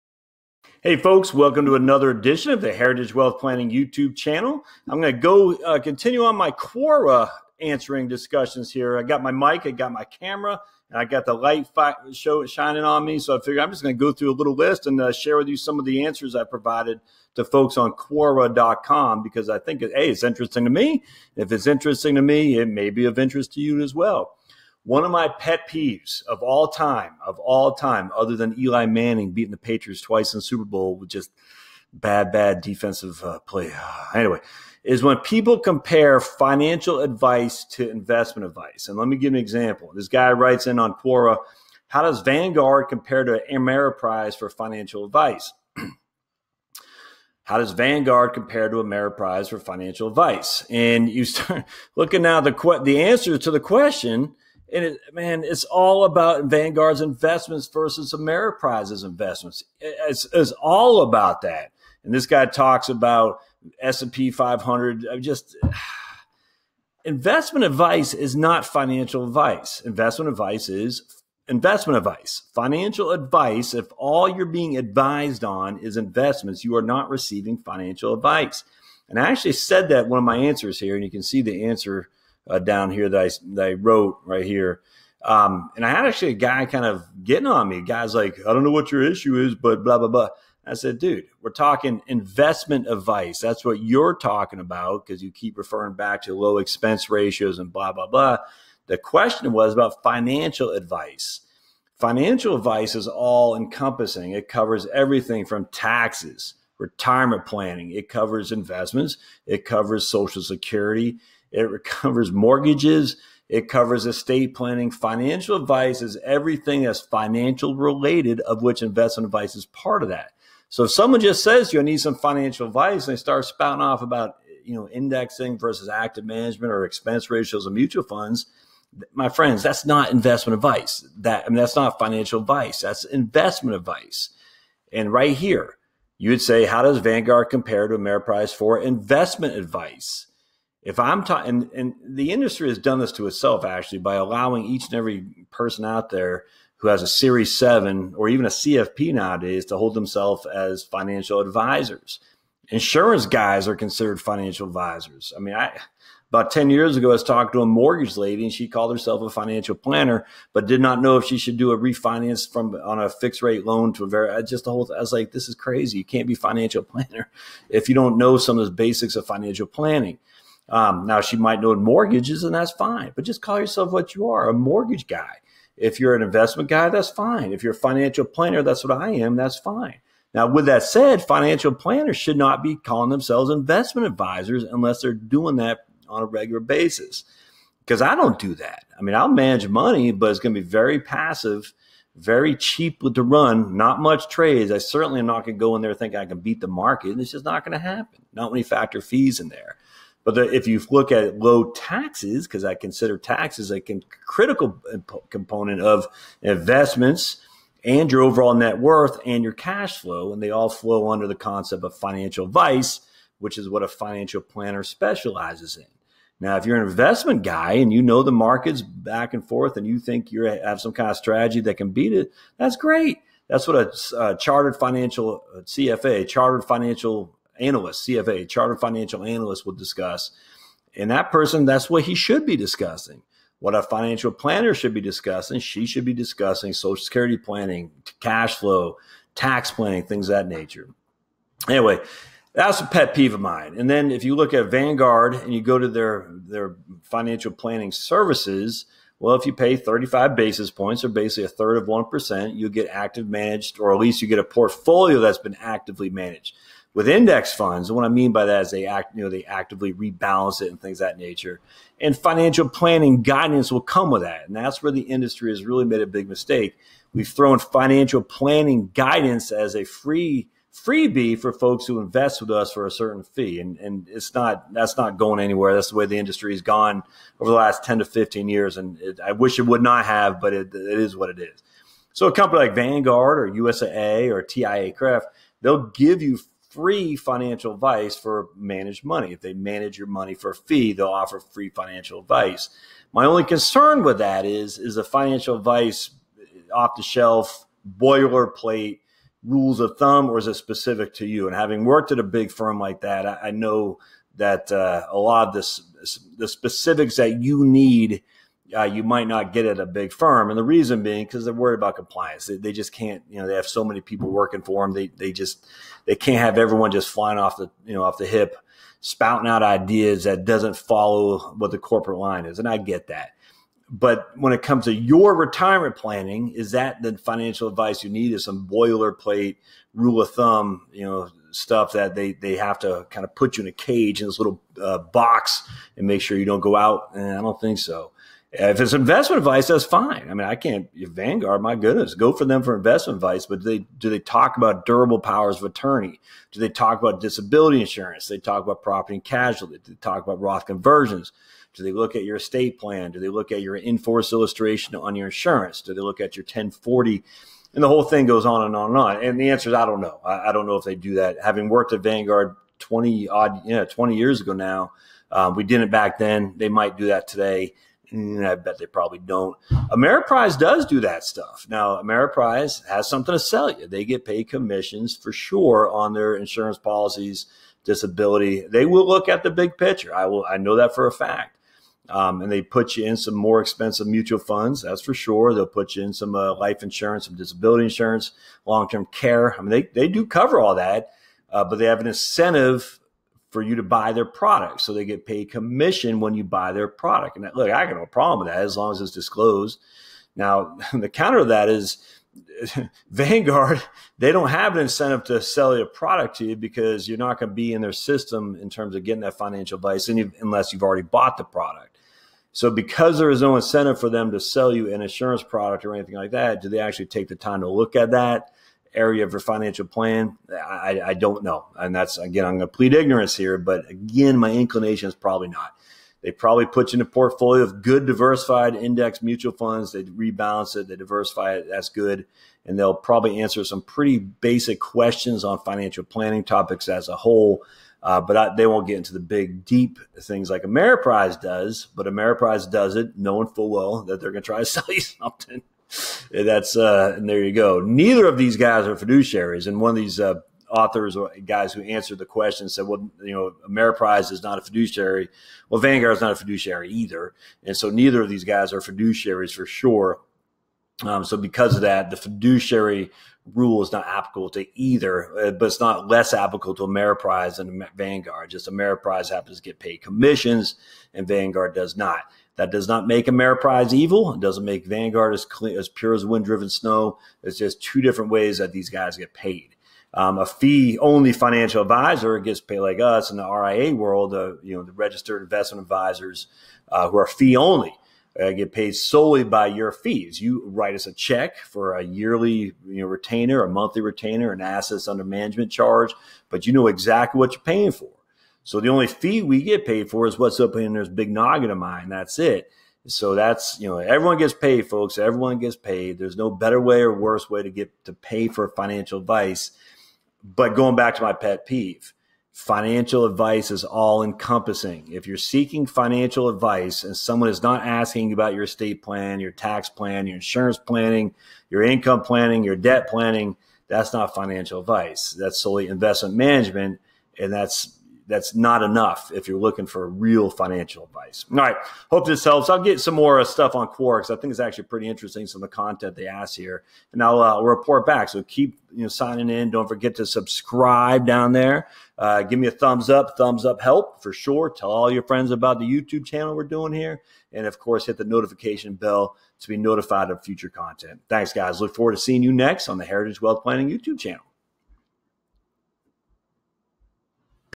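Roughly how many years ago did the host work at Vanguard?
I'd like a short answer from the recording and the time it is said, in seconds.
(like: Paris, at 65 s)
20, at 363 s.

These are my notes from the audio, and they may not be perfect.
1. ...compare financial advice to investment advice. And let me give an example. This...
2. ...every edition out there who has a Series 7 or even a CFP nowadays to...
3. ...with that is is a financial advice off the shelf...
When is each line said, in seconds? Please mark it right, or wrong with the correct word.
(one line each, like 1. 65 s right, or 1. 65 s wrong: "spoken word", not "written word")
1. 35 s right
2. 144 s wrong: "person", not "edition"
3. 294 s right.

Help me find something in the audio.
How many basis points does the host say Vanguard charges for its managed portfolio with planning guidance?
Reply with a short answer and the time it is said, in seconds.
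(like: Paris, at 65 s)
35, at 249 s.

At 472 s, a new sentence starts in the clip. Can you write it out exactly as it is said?
That does not make Ameriprise evil.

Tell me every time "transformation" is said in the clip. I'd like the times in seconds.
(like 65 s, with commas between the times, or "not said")
not said.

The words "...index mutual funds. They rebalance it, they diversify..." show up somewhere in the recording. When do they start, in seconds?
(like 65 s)
428 s.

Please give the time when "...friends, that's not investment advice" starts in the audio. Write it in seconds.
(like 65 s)
129 s.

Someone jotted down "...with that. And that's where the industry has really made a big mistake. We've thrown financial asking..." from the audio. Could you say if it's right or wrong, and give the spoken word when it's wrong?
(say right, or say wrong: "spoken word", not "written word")
wrong: "planning", not "asking".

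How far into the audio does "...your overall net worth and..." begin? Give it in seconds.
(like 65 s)
208 s.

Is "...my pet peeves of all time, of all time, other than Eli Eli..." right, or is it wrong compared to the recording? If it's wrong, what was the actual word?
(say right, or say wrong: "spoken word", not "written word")
wrong: "Manning", not "Eli".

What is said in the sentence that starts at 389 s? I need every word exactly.
I mean, they they do cover all that, uh, but they have an incentive for you to buy their product.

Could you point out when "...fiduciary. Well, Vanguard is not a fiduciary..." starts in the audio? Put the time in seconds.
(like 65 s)
454 s.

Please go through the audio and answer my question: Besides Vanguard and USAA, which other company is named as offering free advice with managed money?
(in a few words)
TIAA-CREF.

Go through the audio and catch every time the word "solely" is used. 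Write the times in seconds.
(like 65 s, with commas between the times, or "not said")
488 s, 525 s.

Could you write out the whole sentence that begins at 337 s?
And eh, I don't think so.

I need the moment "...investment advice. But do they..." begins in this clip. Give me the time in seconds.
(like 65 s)
342 s.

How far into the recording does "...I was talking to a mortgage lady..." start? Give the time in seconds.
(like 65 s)
157 s.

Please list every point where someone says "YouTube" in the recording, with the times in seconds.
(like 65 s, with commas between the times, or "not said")
3 s, 545 s, 553 s.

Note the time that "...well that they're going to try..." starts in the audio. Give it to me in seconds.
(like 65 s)
443 s.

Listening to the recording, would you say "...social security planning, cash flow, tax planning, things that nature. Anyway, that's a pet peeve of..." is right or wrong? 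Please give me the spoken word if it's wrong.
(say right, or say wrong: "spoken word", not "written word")
right.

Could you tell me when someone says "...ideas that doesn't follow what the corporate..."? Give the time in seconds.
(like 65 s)
319 s.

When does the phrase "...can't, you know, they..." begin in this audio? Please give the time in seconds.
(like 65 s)
312 s.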